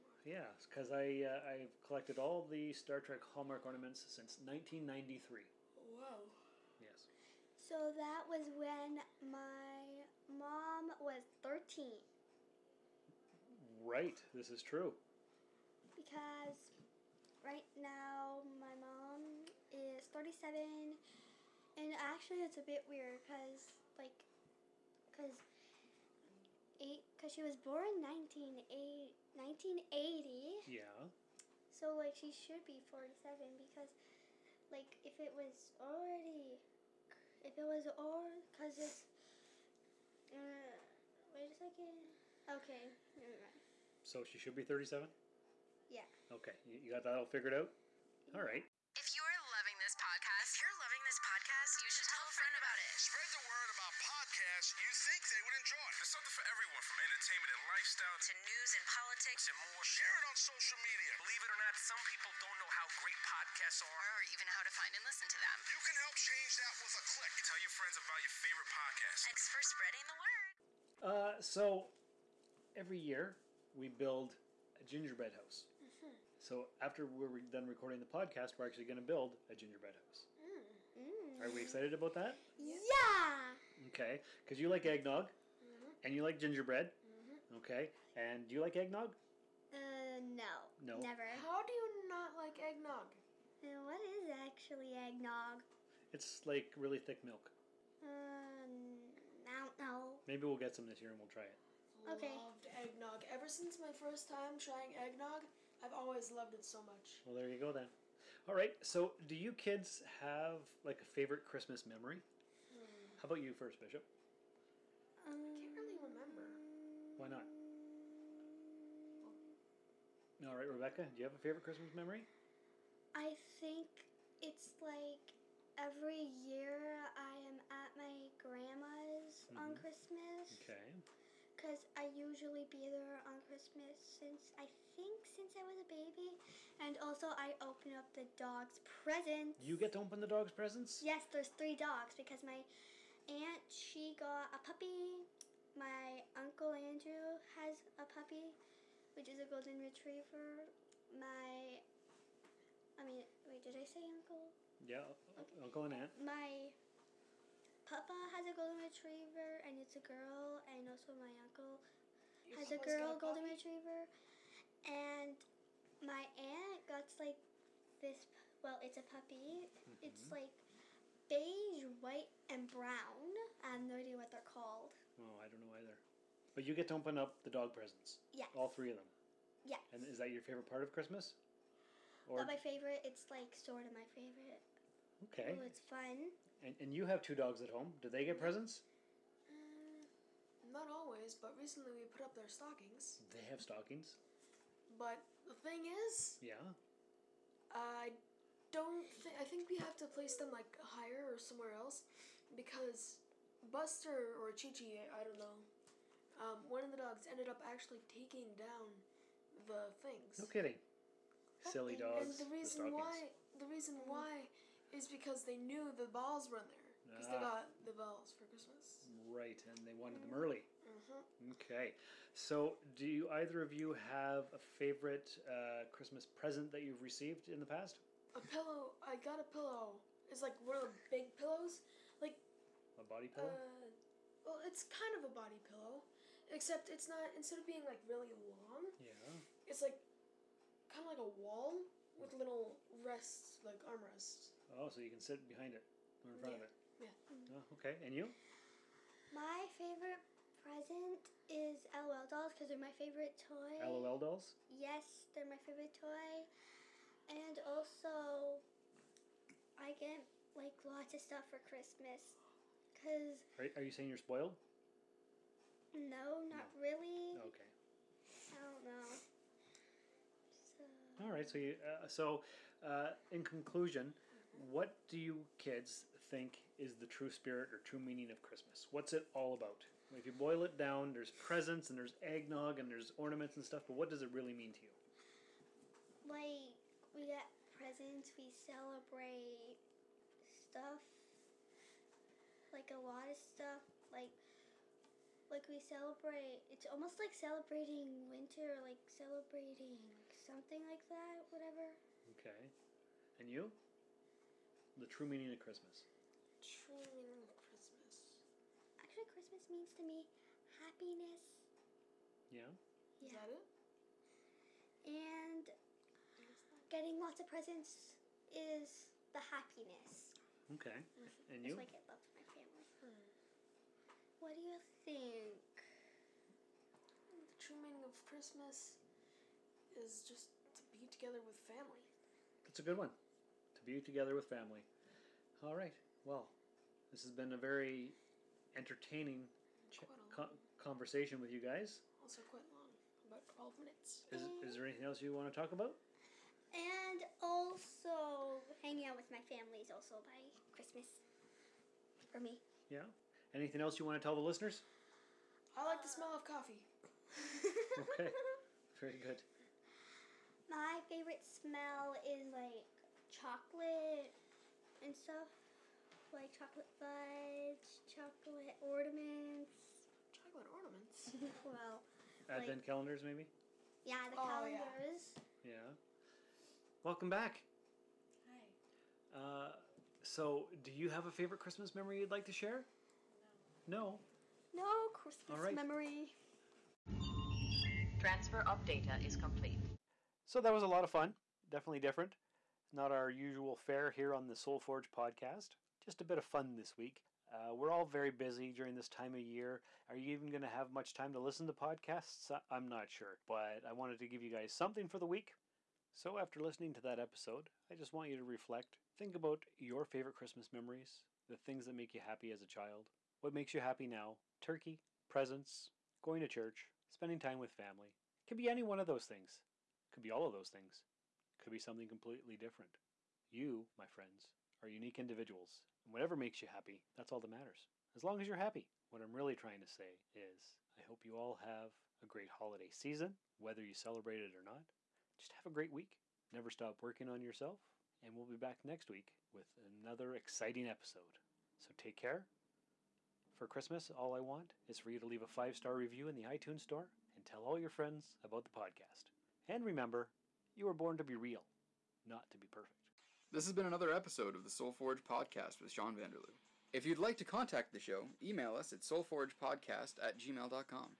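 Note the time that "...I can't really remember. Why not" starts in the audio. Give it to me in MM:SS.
01:55.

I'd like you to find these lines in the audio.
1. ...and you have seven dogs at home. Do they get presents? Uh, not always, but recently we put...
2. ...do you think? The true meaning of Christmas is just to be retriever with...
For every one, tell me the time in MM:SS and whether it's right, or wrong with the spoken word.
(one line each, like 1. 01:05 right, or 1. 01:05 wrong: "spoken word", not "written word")
1. 03:06 wrong: "two", not "seven"
2. 05:24 wrong: "together", not "retriever".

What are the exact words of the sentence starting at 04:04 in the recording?
Oh, so you can sit behind it or in front yeah.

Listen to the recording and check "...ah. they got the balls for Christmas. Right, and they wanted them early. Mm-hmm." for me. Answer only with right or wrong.
right.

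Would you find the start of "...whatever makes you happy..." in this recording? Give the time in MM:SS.
07:06.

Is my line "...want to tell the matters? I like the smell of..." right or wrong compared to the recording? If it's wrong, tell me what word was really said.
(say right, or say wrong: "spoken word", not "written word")
wrong: "listeners", not "matters".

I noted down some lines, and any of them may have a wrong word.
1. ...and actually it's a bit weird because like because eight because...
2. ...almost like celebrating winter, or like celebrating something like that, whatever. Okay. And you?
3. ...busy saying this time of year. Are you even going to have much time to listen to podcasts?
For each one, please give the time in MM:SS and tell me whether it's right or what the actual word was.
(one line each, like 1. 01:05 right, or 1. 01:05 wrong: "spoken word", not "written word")
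1. 00:21 right
2. 04:56 right
3. 06:38 wrong: "during", not "saying".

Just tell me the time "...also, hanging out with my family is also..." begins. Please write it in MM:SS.
05:47.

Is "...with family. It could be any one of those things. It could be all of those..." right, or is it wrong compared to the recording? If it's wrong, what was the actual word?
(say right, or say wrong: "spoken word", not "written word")
right.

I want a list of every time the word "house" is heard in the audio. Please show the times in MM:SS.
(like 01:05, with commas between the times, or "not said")
01:15, 01:20.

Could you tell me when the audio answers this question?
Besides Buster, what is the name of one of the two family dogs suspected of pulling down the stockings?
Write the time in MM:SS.
03:24.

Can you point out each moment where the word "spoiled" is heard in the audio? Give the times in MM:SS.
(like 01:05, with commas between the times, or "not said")
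04:24.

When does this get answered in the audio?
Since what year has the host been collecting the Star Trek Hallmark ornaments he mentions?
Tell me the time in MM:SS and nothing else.
00:04.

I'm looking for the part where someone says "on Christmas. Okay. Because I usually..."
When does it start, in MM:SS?
02:09.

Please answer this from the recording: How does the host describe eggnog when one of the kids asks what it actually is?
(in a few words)
Really thick milk.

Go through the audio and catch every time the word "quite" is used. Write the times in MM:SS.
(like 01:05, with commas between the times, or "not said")
05:42.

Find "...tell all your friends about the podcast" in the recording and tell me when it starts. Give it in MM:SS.
07:27.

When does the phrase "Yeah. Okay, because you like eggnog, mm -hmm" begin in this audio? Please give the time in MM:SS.
01:22.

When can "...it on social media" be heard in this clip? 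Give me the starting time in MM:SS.
01:00.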